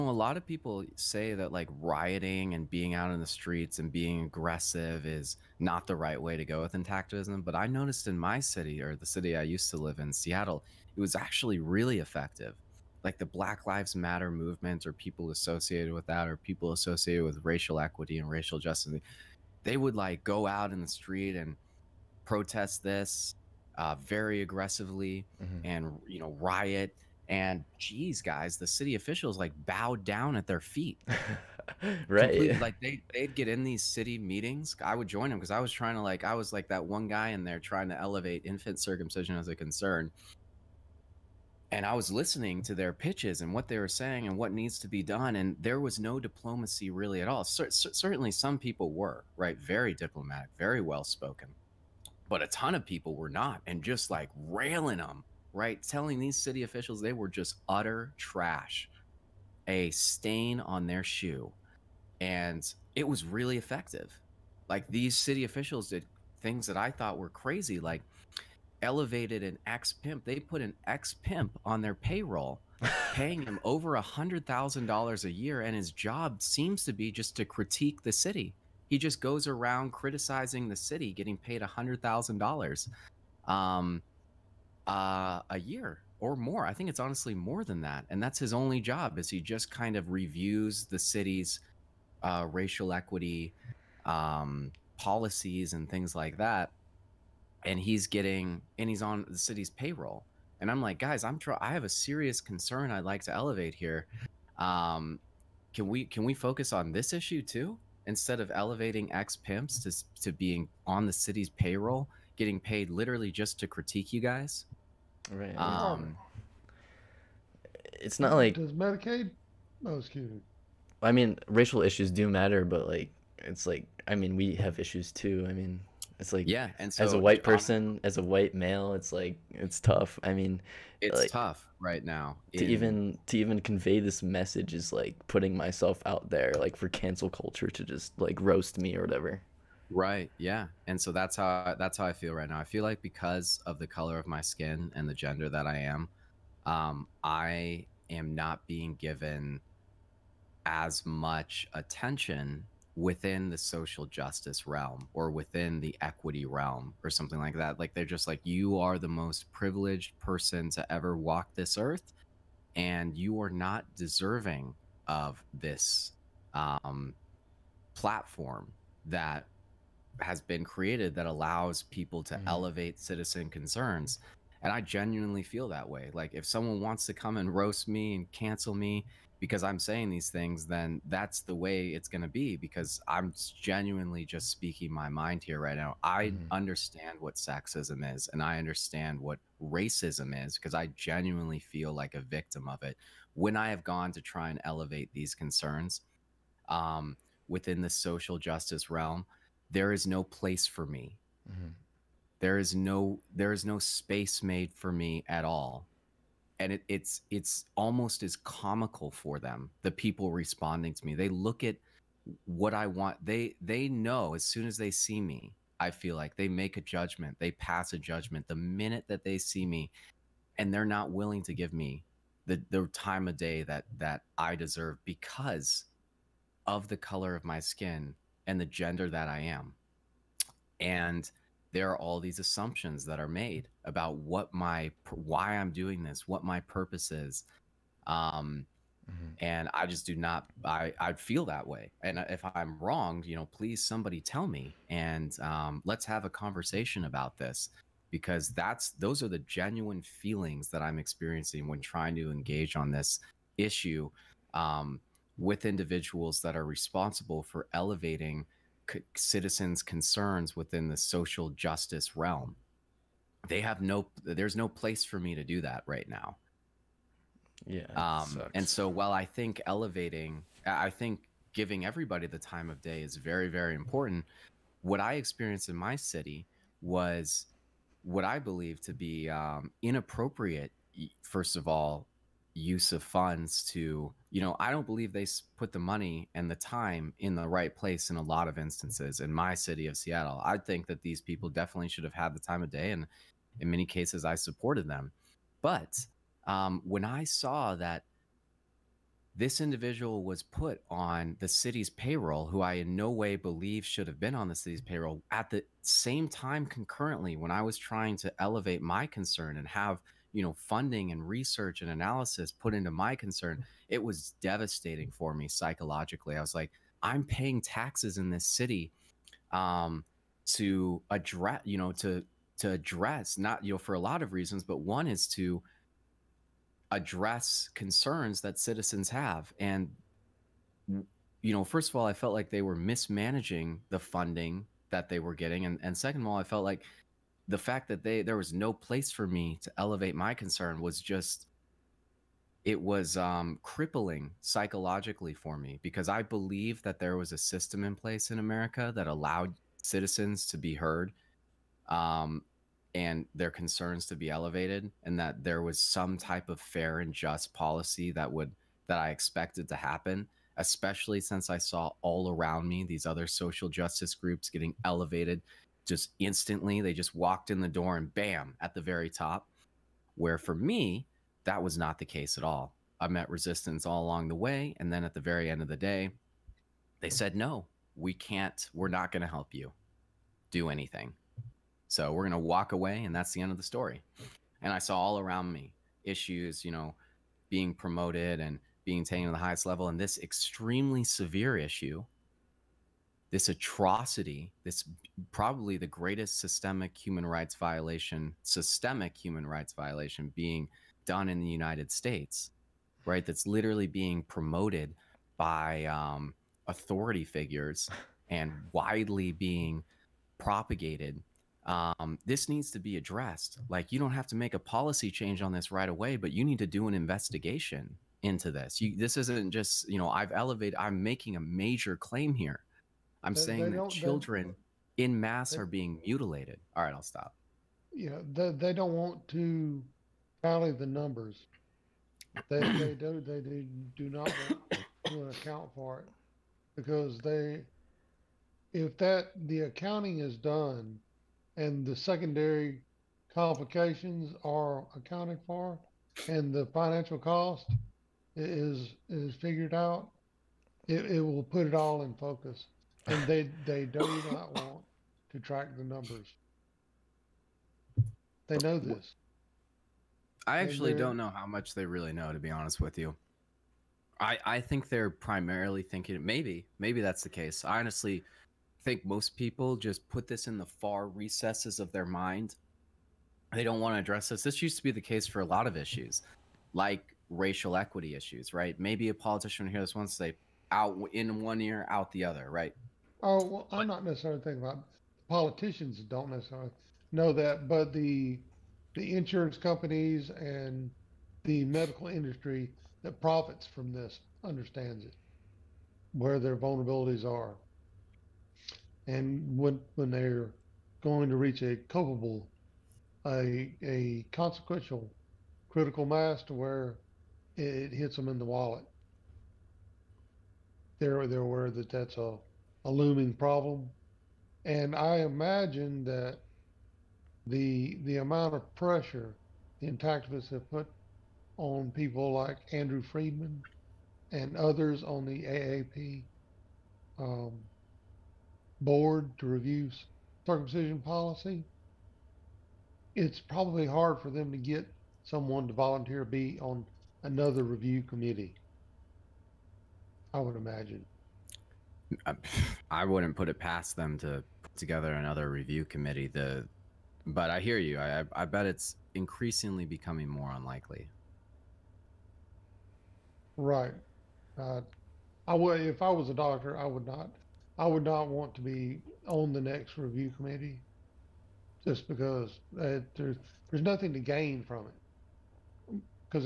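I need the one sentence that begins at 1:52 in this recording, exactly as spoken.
getting paid literally just to critique you guys.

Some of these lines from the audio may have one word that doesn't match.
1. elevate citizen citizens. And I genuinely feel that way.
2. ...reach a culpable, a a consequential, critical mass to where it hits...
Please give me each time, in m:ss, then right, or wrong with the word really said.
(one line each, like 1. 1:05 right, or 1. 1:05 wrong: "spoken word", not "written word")
1. 2:52 wrong: "concerns", not "citizens"
2. 8:21 right.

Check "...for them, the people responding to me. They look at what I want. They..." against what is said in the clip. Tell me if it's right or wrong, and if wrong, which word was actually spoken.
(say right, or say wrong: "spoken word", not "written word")
right.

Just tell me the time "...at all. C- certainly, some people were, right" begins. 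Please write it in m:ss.
0:47.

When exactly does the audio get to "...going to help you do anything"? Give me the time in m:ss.
6:19.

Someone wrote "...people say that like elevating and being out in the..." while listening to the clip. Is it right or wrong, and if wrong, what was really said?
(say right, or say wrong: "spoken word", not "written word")
wrong: "rioting", not "elevating".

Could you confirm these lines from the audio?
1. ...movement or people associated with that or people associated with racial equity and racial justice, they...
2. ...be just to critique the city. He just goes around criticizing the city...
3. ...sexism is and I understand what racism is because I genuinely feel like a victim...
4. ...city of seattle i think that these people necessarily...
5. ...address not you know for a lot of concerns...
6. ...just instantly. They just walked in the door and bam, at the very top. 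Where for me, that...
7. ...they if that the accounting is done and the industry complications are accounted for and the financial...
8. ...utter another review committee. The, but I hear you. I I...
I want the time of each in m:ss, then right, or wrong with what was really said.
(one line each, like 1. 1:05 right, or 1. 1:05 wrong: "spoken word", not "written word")
1. 0:14 right
2. 1:16 right
3. 3:07 right
4. 4:49 wrong: "definitely", not "necessarily"
5. 5:22 wrong: "reasons", not "concerns"
6. 6:05 right
7. 7:17 wrong: "secondary", not "industry"
8. 9:04 wrong: "together", not "utter".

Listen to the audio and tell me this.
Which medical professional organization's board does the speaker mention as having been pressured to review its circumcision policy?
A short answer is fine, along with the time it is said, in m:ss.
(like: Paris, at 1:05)
AAP, at 8:45.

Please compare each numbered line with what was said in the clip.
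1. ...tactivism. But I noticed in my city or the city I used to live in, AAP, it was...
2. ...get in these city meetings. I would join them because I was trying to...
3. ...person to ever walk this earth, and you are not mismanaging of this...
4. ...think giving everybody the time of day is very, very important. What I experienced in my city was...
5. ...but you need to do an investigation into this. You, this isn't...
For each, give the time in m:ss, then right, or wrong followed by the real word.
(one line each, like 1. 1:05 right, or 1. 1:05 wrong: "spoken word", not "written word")
1. 0:06 wrong: "Seattle", not "AAP"
2. 0:33 right
3. 2:40 wrong: "deserving", not "mismanaging"
4. 4:30 right
5. 6:56 right.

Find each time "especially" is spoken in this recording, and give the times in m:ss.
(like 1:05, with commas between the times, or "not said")
6:00.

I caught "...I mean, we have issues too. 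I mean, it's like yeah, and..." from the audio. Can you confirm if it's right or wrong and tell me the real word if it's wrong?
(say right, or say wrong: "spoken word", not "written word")
right.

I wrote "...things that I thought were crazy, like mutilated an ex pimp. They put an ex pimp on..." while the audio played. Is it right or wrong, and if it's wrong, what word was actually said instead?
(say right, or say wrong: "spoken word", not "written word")
wrong: "elevated", not "mutilated".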